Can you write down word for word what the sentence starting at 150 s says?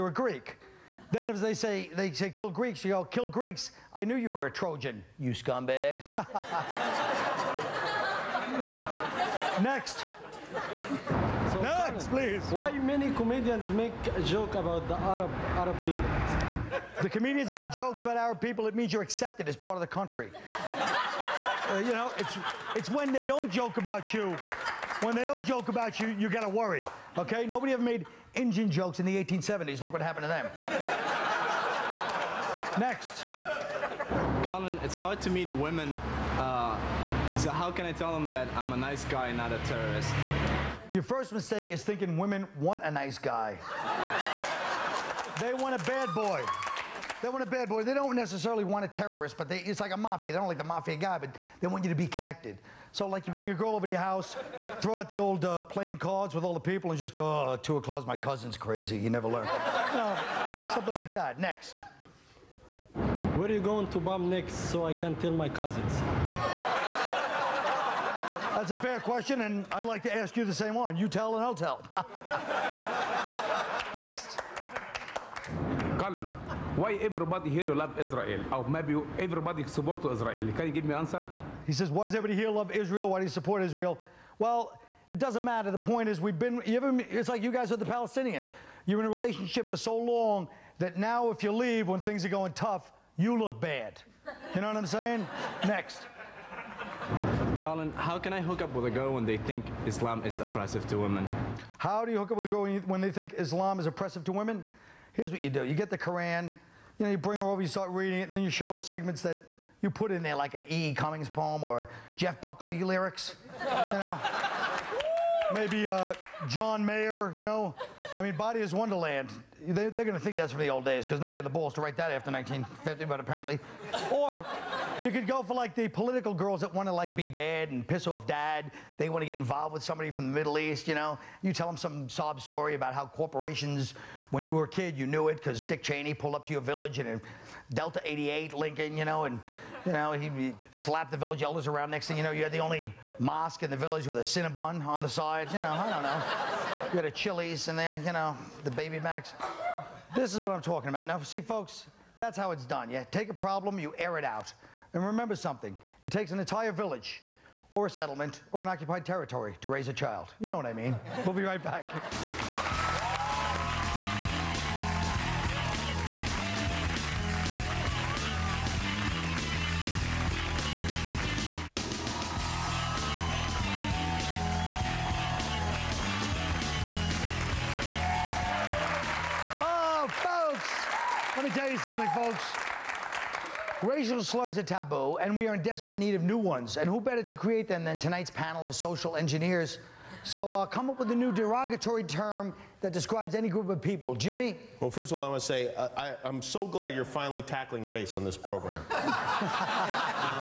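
This is what I'm talking about.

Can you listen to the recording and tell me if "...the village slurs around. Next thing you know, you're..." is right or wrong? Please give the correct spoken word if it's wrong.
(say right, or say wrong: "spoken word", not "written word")
wrong: "elders", not "slurs".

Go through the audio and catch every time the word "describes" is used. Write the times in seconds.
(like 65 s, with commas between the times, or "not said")
192 s.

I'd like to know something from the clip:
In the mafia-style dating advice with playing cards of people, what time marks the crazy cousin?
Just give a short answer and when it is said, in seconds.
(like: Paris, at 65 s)
two o'clock, at 57 s.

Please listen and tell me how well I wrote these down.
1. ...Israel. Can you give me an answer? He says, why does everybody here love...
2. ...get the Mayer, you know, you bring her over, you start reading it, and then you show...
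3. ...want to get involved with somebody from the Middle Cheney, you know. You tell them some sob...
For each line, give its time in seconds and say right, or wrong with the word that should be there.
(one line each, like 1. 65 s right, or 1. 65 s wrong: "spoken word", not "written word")
1. 80 s right
2. 105 s wrong: "Koran", not "Mayer"
3. 129 s wrong: "East", not "Cheney".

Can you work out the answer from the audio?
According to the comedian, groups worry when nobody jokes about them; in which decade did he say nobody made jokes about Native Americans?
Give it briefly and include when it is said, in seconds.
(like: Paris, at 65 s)
1870s, at 29 s.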